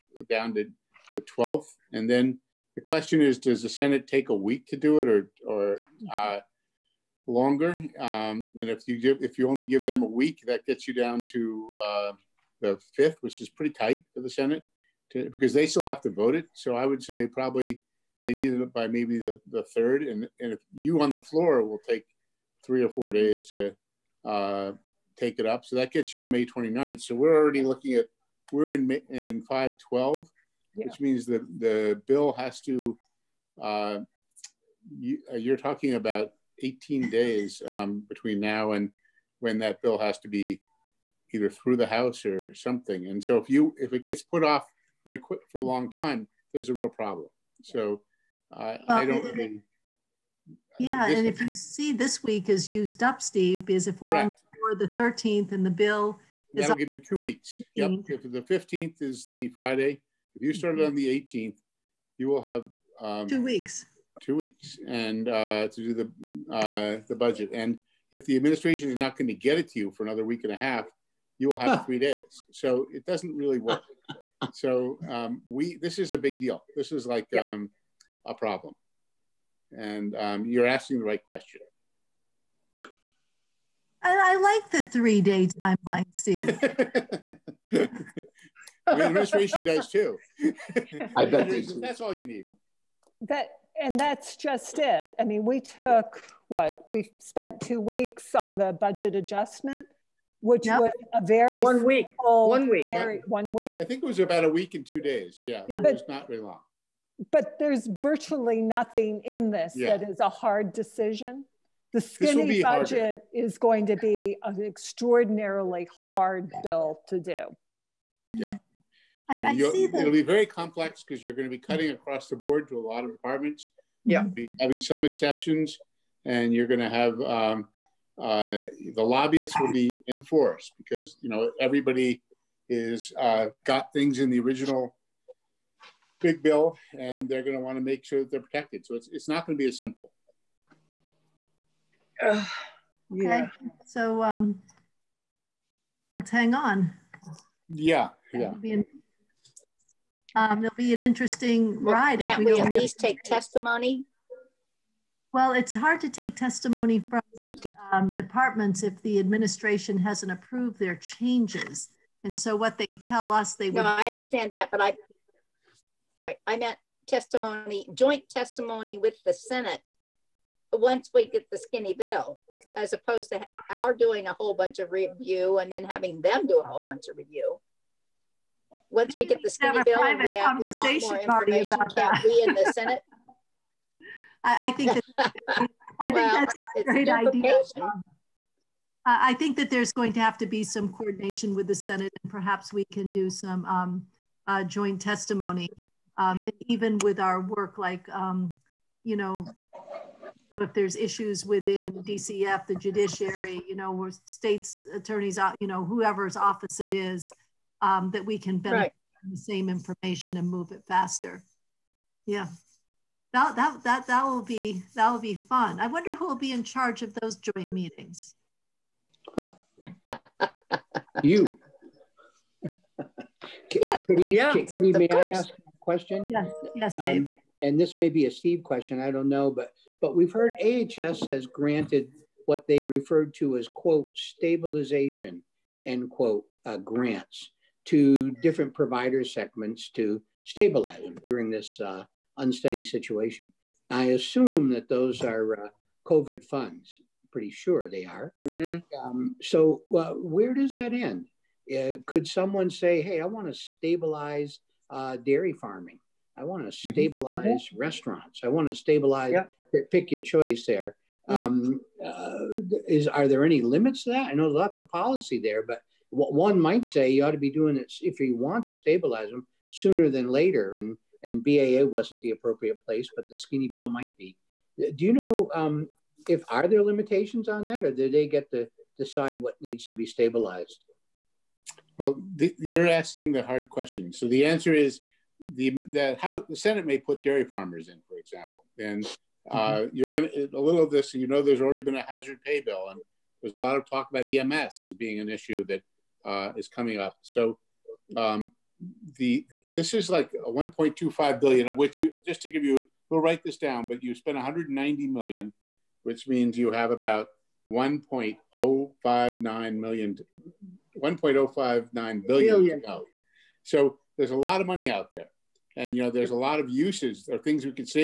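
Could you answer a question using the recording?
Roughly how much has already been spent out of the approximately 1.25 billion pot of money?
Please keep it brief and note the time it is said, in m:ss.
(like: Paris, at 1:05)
190 million, at 5:04.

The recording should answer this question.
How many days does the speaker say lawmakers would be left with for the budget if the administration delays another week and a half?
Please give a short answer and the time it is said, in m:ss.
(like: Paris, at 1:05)
3 days, at 1:11.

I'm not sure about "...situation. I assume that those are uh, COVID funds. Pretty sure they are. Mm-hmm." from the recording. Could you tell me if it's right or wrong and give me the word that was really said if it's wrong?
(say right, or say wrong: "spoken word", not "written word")
right.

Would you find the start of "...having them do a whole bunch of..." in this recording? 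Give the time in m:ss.
2:55.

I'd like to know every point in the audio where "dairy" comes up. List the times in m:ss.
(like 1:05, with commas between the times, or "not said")
4:15, 4:47.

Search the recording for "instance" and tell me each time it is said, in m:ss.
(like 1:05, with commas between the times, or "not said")
not said.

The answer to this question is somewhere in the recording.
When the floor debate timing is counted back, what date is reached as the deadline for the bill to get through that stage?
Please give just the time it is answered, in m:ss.
0:26.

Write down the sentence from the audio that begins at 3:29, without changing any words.
from the same information and move it faster.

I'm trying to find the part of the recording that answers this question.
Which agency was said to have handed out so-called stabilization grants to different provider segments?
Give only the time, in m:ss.
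3:50.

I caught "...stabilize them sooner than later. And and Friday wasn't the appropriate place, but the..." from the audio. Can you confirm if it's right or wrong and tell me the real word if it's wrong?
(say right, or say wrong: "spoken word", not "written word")
wrong: "BAA", not "Friday".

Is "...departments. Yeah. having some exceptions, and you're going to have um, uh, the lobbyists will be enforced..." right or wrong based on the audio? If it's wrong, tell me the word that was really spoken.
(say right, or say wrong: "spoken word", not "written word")
right.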